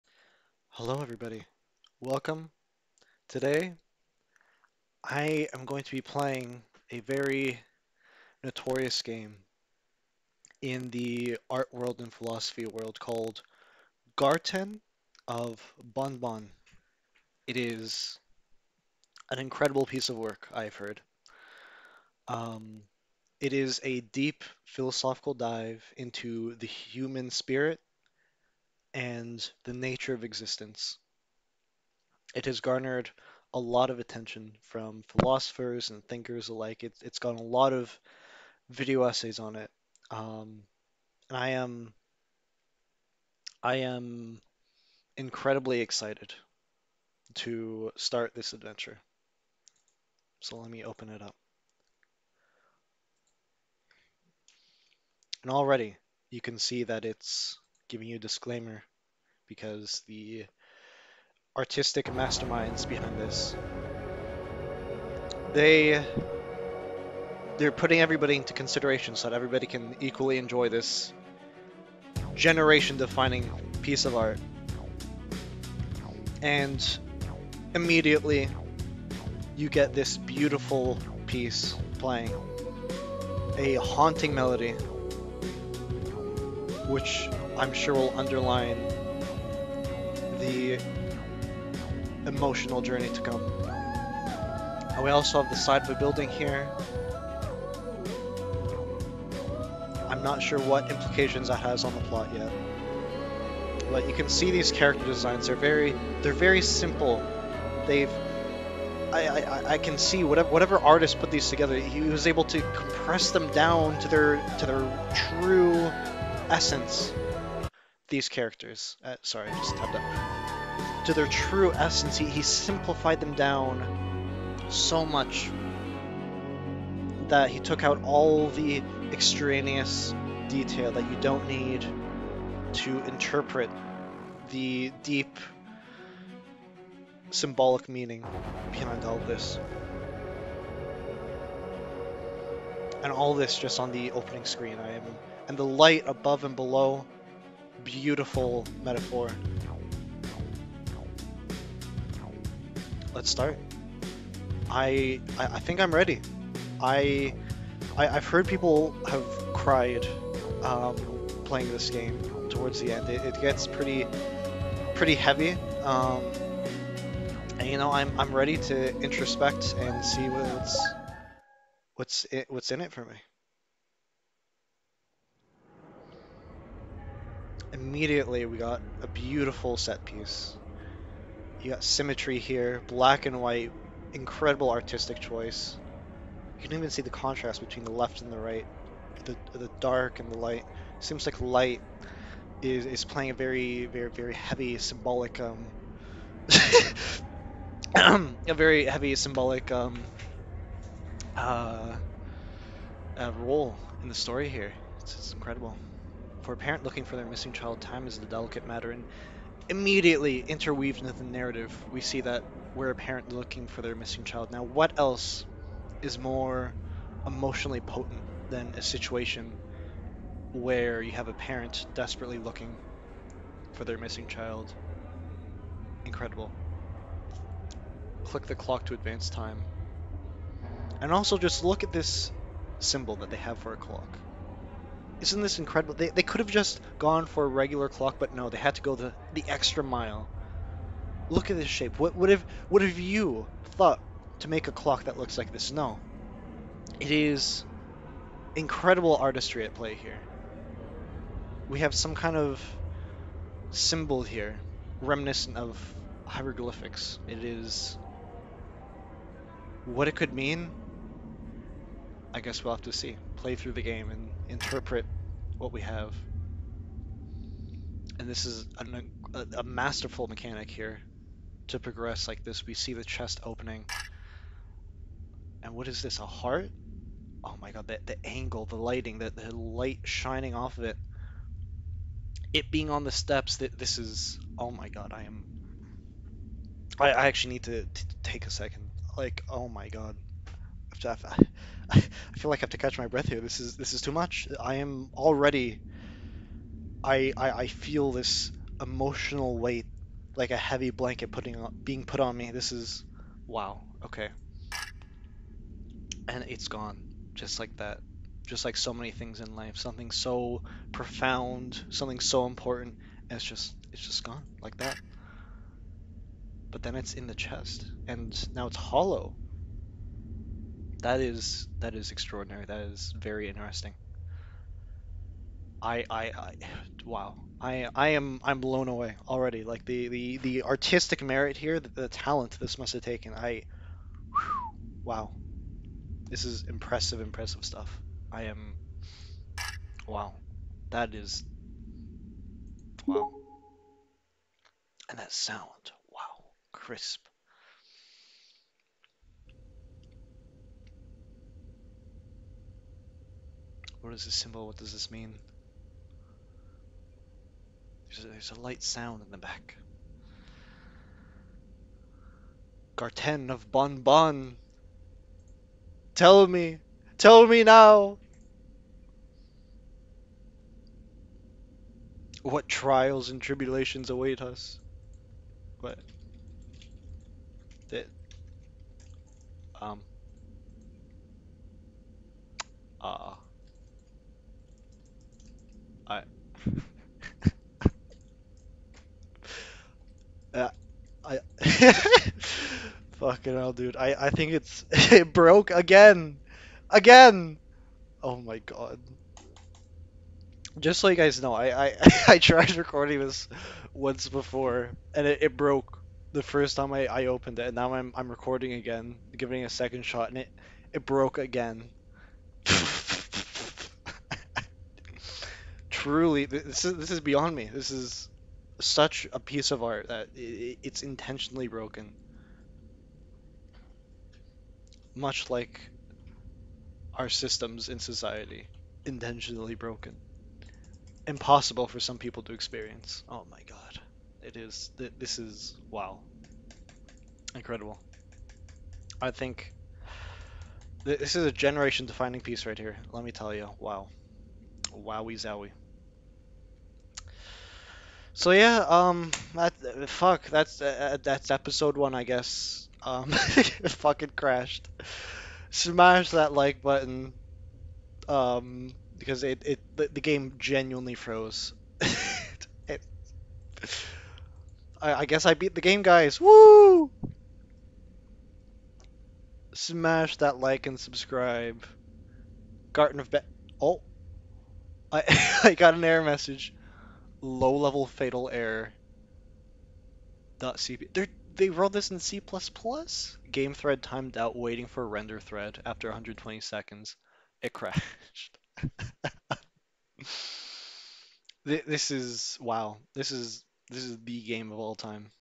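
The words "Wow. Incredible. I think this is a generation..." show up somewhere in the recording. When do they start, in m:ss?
7:15.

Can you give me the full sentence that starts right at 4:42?
It being on the steps, that this is...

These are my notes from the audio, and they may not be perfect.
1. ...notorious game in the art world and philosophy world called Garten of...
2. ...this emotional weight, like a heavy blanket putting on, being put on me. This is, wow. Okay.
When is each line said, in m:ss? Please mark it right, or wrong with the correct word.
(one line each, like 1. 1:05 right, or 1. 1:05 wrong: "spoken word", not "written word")
1. 0:08 right
2. 4:58 right.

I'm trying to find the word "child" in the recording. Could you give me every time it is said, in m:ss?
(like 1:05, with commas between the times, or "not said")
3:27, 3:34, 3:44.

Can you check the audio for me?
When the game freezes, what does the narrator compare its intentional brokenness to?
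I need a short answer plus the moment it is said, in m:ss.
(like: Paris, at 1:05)
Our systems in society, at 7:07.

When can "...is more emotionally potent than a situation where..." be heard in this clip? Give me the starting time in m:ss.
3:36.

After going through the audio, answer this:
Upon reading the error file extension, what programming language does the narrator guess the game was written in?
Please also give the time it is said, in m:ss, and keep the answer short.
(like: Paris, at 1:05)
C++, at 8:02.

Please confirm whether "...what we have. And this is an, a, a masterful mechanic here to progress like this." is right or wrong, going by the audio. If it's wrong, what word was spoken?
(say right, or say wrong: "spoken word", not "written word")
right.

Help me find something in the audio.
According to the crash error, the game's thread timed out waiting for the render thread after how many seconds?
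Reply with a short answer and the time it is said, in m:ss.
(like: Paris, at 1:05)
120, at 8:06.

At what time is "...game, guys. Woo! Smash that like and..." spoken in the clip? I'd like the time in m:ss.
7:45.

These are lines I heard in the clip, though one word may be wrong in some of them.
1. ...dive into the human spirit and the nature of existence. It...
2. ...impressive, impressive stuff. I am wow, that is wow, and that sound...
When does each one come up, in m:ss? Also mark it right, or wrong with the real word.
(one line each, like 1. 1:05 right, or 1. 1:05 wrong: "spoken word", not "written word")
1. 0:25 right
2. 5:36 right.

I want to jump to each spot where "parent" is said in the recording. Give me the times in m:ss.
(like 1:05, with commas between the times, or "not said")
3:26, 3:32, 3:41.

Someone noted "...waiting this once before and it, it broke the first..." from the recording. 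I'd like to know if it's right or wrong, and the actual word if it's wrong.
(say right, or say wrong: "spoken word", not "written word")
wrong: "recording", not "waiting".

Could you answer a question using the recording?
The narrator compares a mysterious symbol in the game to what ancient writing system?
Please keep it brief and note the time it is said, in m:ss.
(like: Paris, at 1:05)
Hieroglyphics, at 4:16.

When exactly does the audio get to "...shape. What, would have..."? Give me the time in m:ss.
4:01.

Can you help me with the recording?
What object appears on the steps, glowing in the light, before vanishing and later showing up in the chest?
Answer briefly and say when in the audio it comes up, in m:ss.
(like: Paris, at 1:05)
A heart, at 4:36.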